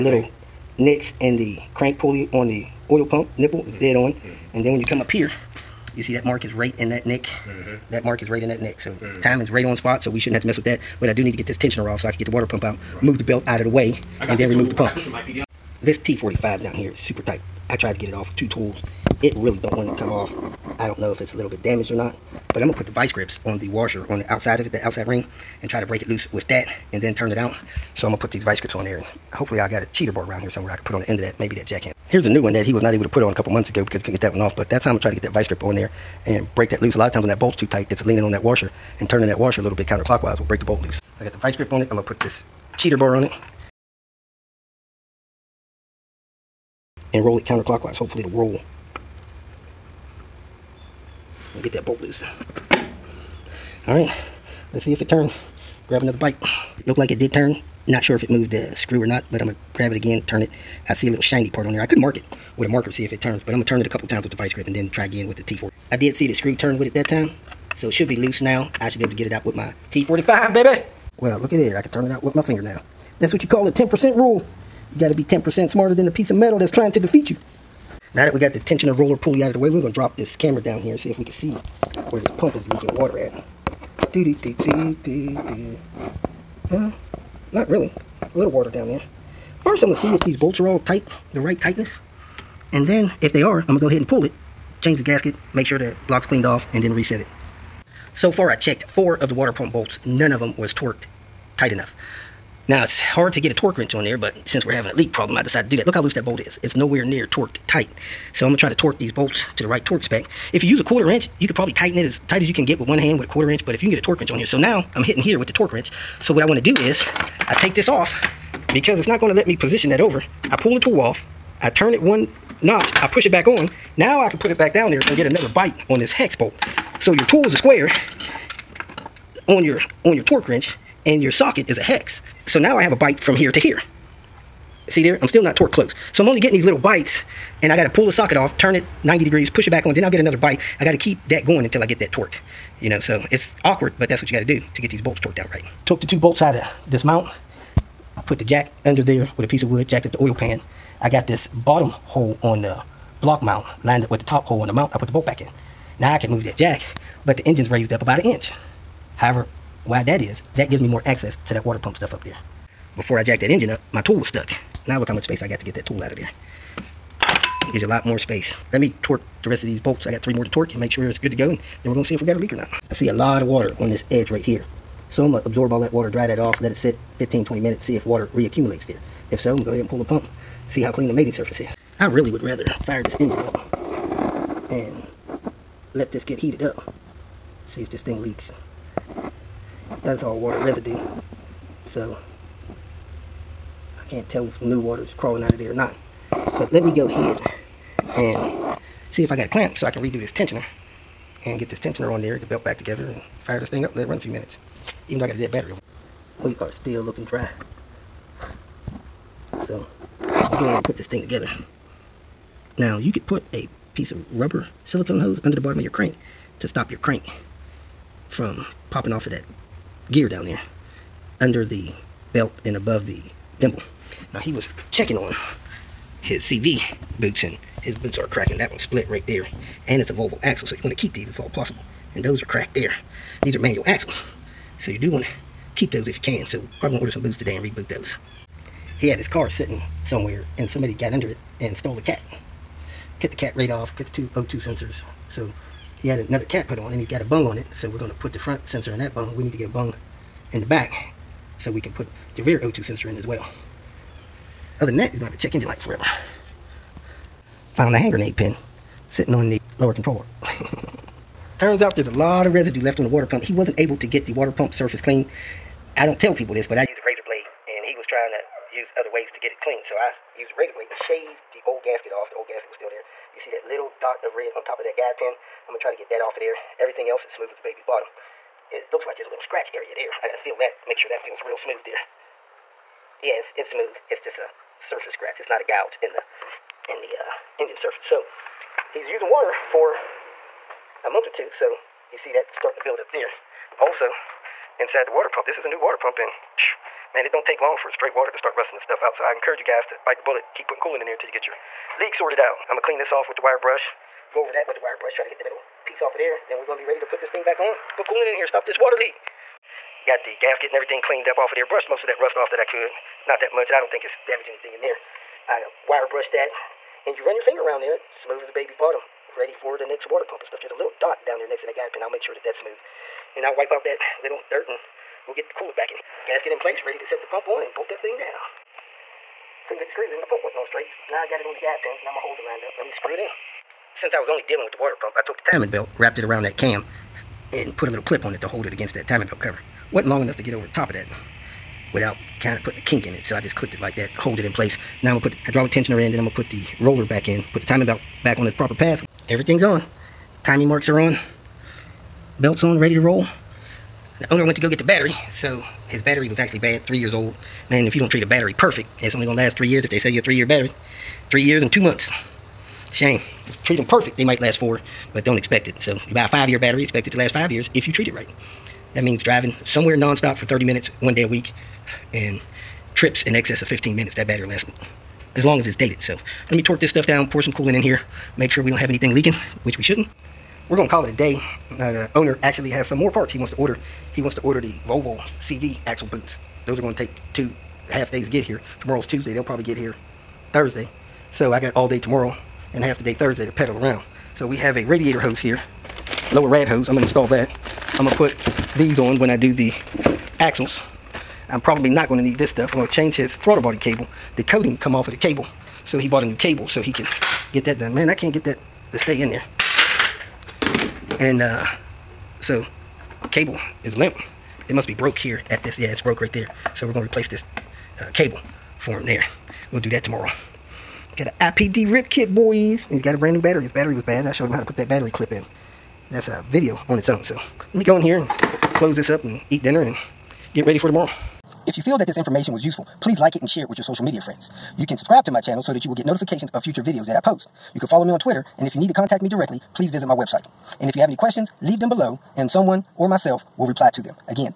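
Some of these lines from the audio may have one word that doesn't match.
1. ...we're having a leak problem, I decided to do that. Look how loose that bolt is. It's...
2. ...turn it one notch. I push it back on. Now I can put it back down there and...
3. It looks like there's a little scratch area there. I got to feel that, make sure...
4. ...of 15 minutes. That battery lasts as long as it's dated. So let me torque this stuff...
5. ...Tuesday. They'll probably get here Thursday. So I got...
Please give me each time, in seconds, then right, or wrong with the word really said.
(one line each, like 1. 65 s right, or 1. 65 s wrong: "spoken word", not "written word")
1. 104 s right
2. 121 s right
3. 278 s right
4. 373 s right
5. 389 s right.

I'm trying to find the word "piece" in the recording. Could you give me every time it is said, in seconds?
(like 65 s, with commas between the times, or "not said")
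76 s, 149 s, 213 s, 305 s.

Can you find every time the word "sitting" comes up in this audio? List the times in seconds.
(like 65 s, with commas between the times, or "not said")
239 s, 259 s.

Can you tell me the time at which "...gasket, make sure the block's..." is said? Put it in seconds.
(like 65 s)
95 s.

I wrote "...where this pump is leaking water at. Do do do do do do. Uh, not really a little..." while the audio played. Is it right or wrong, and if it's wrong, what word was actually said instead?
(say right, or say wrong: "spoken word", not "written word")
right.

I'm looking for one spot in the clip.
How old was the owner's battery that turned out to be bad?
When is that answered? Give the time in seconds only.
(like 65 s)
361 s.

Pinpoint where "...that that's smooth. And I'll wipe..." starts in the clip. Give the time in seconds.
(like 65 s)
322 s.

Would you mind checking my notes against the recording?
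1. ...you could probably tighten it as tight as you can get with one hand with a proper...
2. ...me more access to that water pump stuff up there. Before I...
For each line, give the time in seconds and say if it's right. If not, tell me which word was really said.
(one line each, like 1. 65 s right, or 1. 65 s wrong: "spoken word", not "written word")
1. 111 s wrong: "quarter", not "proper"
2. 160 s right.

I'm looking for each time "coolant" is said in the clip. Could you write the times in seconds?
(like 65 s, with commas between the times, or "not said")
300 s, 308 s, 325 s, 377 s.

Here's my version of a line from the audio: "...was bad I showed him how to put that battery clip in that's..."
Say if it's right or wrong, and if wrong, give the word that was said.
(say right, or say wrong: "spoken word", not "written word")
right.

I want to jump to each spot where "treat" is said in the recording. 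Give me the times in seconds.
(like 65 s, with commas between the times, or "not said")
358 s, 363 s, 367 s.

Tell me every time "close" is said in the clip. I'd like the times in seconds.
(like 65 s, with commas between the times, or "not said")
135 s, 428 s.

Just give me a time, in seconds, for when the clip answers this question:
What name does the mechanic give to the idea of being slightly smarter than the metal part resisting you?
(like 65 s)
73 s.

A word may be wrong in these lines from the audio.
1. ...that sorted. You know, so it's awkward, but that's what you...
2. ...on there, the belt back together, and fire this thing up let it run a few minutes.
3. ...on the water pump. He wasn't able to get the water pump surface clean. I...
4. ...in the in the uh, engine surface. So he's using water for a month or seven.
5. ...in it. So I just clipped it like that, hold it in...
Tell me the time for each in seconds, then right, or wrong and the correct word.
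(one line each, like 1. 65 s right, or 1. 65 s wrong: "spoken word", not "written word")
1. 141 s wrong: "torqued", not "sorted"
2. 202 s right
3. 262 s right
4. 286 s wrong: "two", not "seven"
5. 343 s right.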